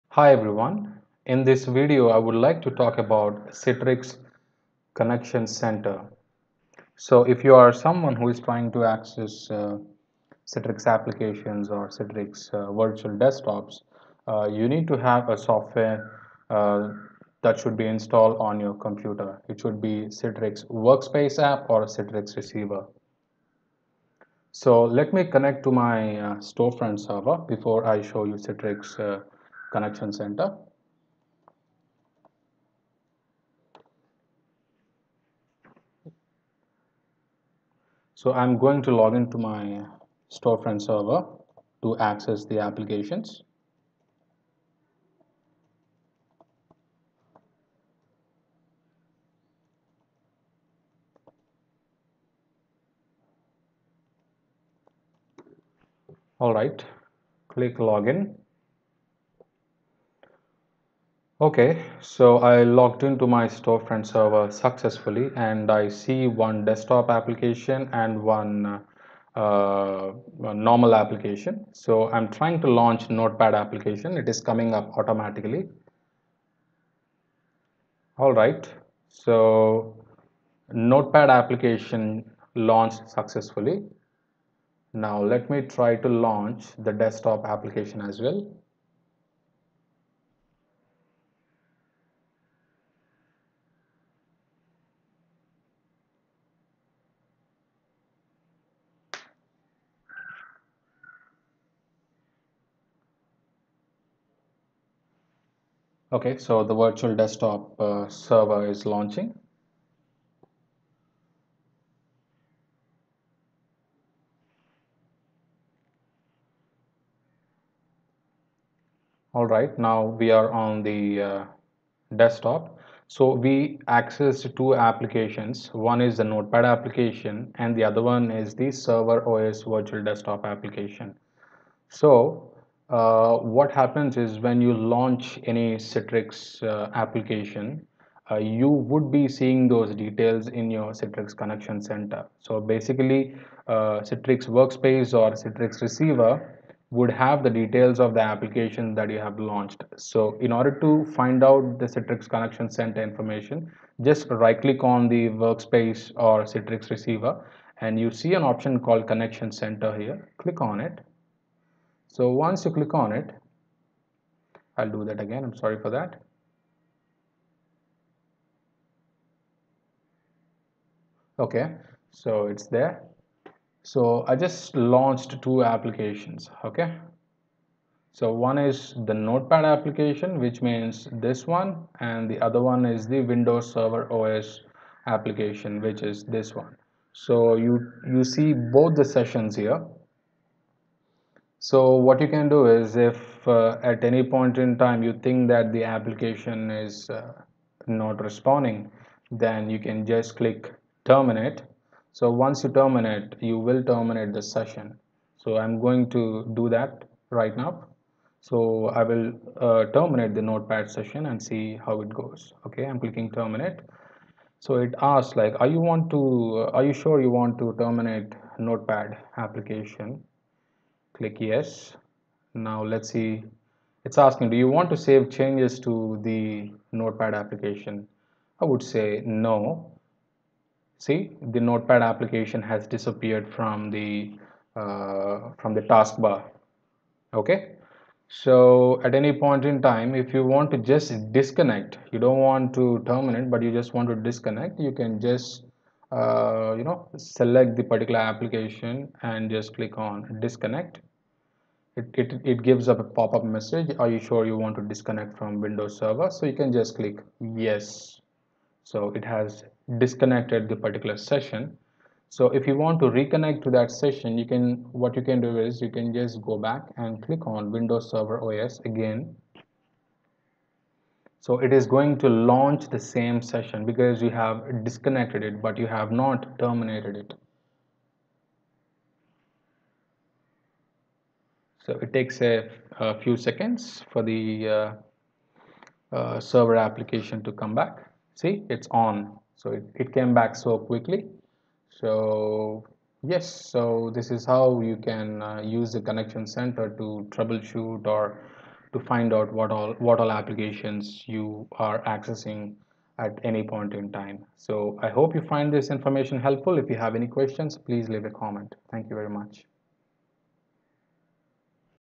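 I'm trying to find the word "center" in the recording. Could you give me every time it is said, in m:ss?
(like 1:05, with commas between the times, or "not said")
0:05, 0:30, 2:21, 2:32, 2:39, 4:56.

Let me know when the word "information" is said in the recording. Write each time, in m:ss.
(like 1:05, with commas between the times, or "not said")
2:33, 5:05.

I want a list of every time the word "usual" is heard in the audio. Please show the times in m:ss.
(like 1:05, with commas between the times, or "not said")
not said.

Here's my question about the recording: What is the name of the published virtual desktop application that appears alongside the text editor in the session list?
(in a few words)
Server OS Virtual Desktop.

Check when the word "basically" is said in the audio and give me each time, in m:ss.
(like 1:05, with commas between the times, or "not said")
2:22.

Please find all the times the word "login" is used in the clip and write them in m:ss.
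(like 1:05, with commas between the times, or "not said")
0:57.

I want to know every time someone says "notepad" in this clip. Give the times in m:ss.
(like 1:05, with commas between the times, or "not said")
1:13, 1:20, 2:06, 2:59, 3:30, 3:38, 3:46, 3:51.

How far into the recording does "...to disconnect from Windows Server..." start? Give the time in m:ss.
4:14.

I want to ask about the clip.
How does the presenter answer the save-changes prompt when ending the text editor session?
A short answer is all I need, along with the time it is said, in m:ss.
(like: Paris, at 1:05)
No, at 3:49.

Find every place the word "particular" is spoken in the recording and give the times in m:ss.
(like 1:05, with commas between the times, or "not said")
4:07, 4:20.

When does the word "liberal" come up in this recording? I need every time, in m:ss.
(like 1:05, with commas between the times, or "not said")
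not said.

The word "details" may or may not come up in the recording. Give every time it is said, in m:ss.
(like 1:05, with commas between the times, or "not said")
2:19, 2:27.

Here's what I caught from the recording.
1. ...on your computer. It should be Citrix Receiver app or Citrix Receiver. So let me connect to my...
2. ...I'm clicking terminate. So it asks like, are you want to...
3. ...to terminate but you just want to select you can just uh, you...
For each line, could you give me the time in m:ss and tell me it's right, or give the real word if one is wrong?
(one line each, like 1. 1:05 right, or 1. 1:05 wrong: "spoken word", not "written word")
1. 0:18 wrong: "Workspace", not "Receiver"
2. 3:32 right
3. 4:02 wrong: "disconnect", not "select".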